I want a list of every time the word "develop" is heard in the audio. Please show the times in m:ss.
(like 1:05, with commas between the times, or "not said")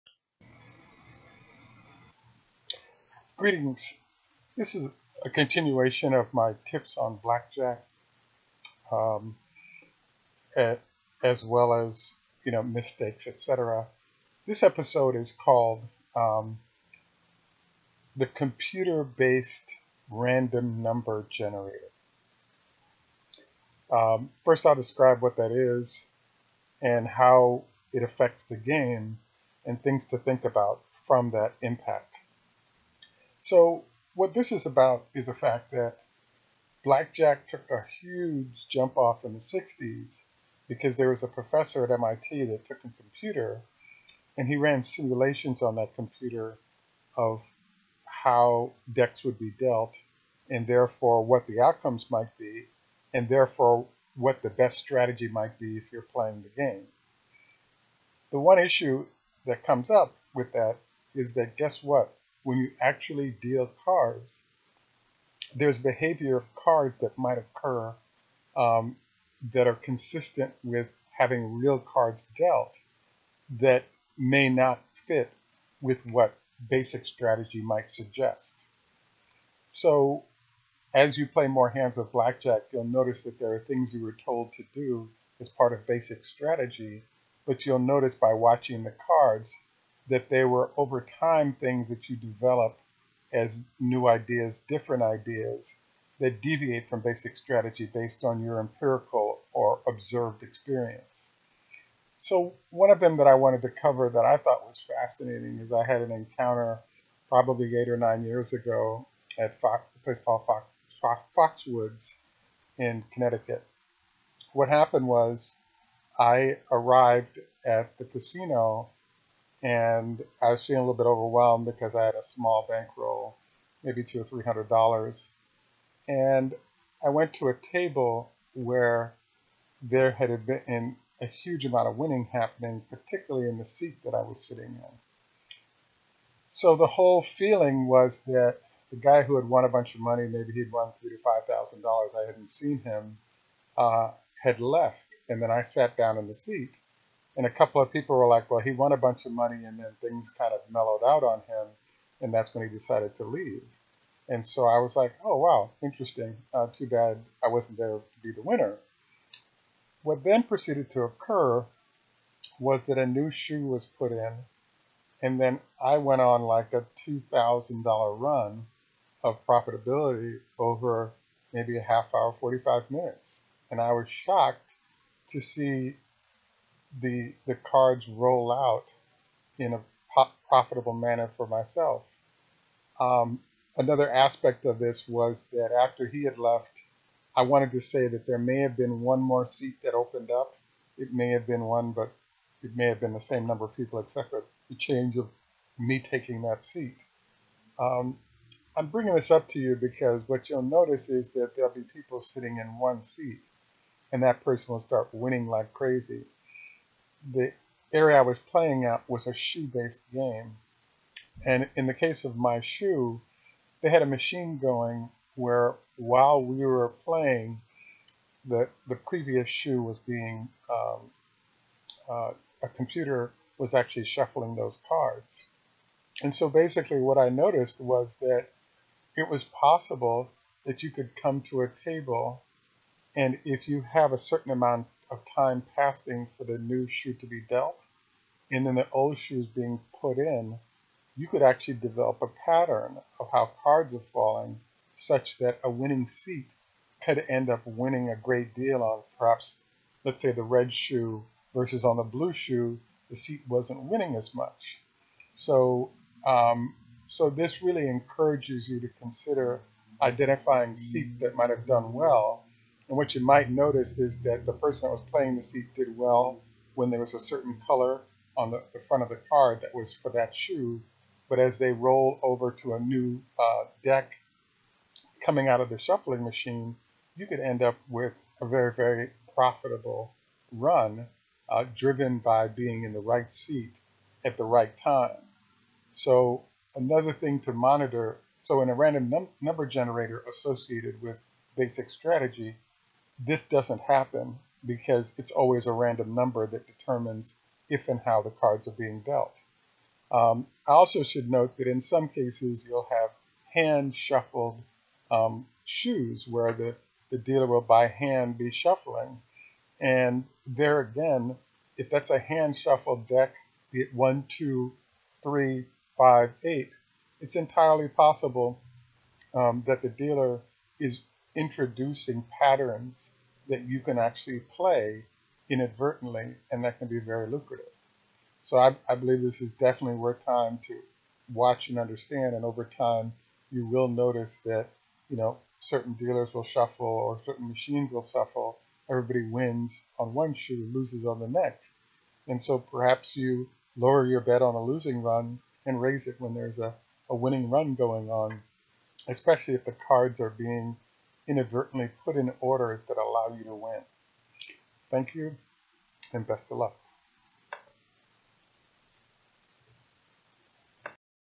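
1:32, 4:01.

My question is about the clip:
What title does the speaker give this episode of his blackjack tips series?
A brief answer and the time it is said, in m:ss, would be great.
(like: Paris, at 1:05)
The computer-based random number generator, at 0:18.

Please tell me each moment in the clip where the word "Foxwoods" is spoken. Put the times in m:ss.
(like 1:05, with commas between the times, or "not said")
1:51.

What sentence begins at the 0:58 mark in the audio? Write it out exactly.
The one issue that comes up with that is that guess what?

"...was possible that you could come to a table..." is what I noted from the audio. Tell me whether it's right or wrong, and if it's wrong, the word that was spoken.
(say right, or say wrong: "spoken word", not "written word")
right.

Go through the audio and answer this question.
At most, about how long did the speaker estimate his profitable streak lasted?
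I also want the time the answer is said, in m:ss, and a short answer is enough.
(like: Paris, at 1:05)
45 minutes, at 2:52.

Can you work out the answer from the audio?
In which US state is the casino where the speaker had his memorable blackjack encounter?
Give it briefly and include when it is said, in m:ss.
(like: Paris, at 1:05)
Connecticut, at 1:53.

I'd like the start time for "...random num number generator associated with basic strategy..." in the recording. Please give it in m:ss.
4:48.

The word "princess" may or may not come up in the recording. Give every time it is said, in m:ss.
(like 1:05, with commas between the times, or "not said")
not said.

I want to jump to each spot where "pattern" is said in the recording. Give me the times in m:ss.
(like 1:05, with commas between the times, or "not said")
4:02, 5:22.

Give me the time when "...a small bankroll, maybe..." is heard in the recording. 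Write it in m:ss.
2:02.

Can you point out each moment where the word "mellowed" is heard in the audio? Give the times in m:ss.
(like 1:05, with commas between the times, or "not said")
2:30.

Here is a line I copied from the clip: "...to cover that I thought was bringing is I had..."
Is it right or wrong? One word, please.
wrong.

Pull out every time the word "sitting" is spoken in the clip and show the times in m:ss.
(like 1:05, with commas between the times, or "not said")
2:14, 3:22.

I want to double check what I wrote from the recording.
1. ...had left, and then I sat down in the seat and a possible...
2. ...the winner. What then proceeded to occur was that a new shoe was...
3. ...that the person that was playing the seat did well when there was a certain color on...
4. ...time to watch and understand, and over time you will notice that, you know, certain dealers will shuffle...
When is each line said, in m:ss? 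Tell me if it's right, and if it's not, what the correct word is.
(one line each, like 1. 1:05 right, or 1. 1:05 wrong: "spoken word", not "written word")
1. 2:24 wrong: "couple", not "possible"
2. 2:38 right
3. 4:24 right
4. 5:30 right.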